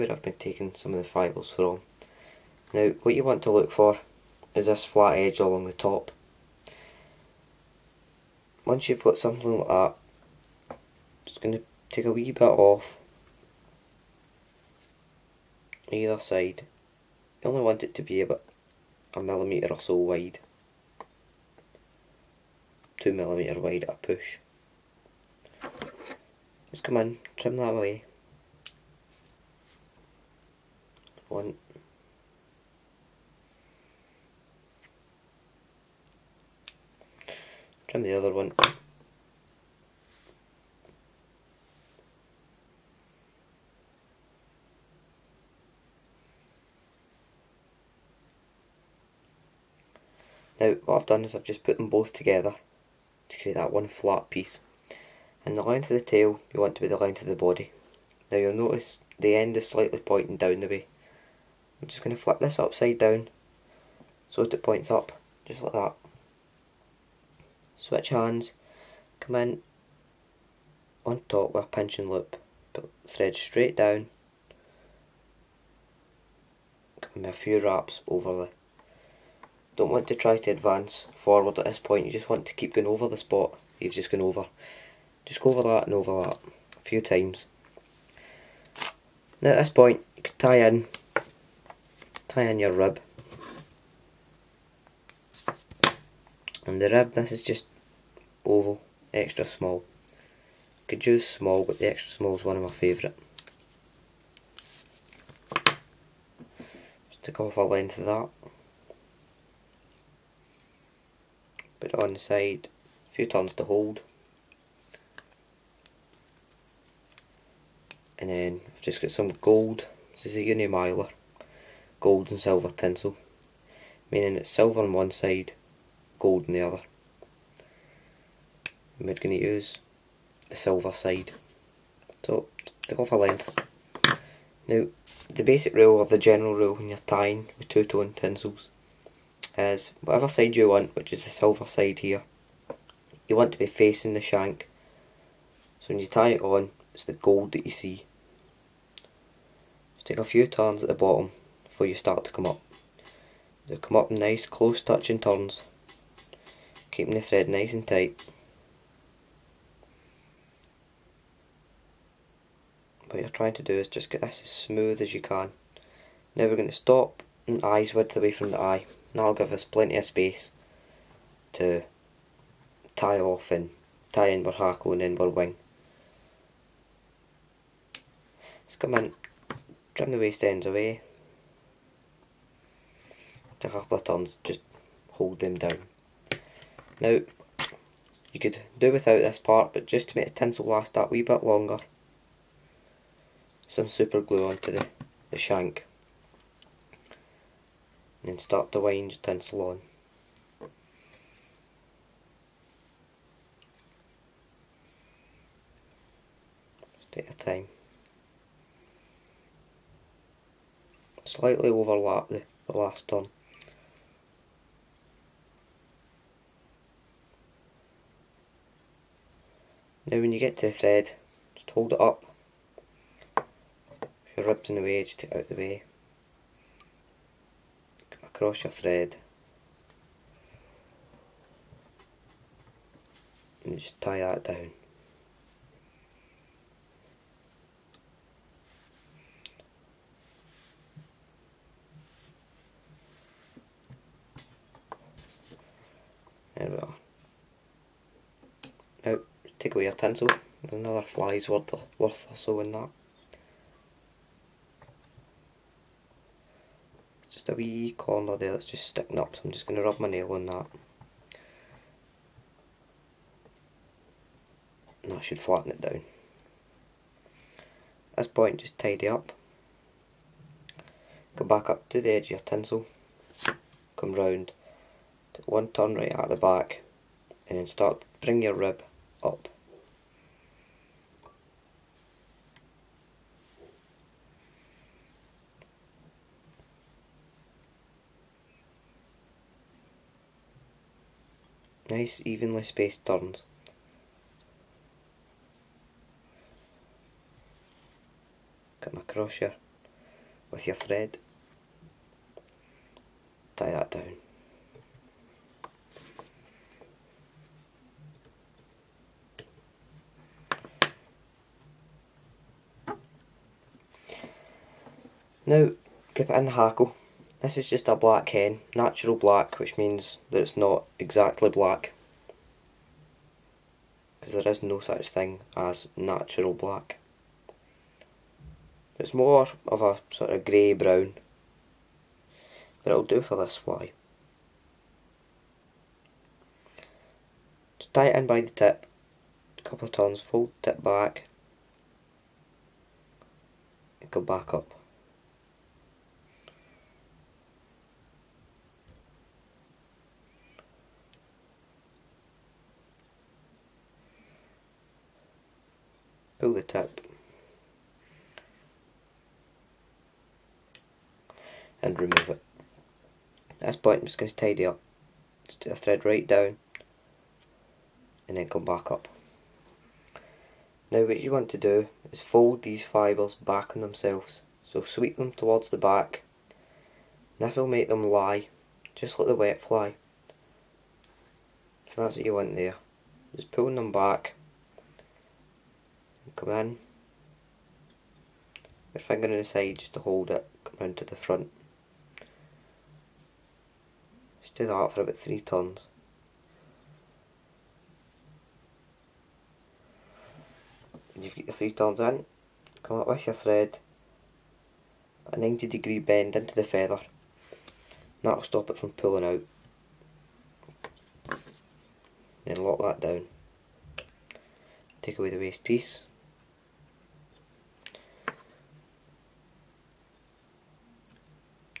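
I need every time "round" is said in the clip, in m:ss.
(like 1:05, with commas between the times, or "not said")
4:34, 6:30.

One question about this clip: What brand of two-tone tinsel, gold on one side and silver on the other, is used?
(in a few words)
Uni-Mylar.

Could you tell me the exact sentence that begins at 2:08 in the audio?
And we're going to use the silver side.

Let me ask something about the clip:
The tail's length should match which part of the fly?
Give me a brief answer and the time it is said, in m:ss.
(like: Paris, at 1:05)
The body, at 0:56.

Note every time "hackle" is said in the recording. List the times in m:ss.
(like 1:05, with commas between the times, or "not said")
2:54, 5:16.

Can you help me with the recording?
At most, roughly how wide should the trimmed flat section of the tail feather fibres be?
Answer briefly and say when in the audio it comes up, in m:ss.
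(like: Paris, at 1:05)
2 millimetres, at 0:22.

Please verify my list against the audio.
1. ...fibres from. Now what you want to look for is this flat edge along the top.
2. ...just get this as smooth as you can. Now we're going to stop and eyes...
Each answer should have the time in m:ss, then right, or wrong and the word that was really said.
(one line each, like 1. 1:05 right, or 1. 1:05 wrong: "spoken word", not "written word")
1. 0:01 right
2. 2:43 right.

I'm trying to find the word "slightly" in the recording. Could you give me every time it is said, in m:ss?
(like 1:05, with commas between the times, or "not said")
0:59, 3:31.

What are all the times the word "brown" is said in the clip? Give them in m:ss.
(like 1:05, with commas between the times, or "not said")
5:30.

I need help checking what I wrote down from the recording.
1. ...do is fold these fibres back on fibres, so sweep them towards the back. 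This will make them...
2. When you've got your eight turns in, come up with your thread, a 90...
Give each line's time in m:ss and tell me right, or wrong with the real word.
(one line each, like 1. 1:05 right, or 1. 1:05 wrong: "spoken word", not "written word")
1. 6:11 wrong: "themselves", not "fibres"
2. 6:41 wrong: "three", not "eight".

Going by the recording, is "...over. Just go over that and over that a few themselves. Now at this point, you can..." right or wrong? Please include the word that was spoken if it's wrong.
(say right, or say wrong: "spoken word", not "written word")
wrong: "times", not "themselves".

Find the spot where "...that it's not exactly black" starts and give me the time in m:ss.
5:20.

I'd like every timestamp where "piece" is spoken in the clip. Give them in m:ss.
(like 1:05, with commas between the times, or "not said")
0:54, 6:55.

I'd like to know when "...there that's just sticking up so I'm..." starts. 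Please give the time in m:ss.
4:18.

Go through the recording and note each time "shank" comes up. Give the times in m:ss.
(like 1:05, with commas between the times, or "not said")
2:24, 3:15.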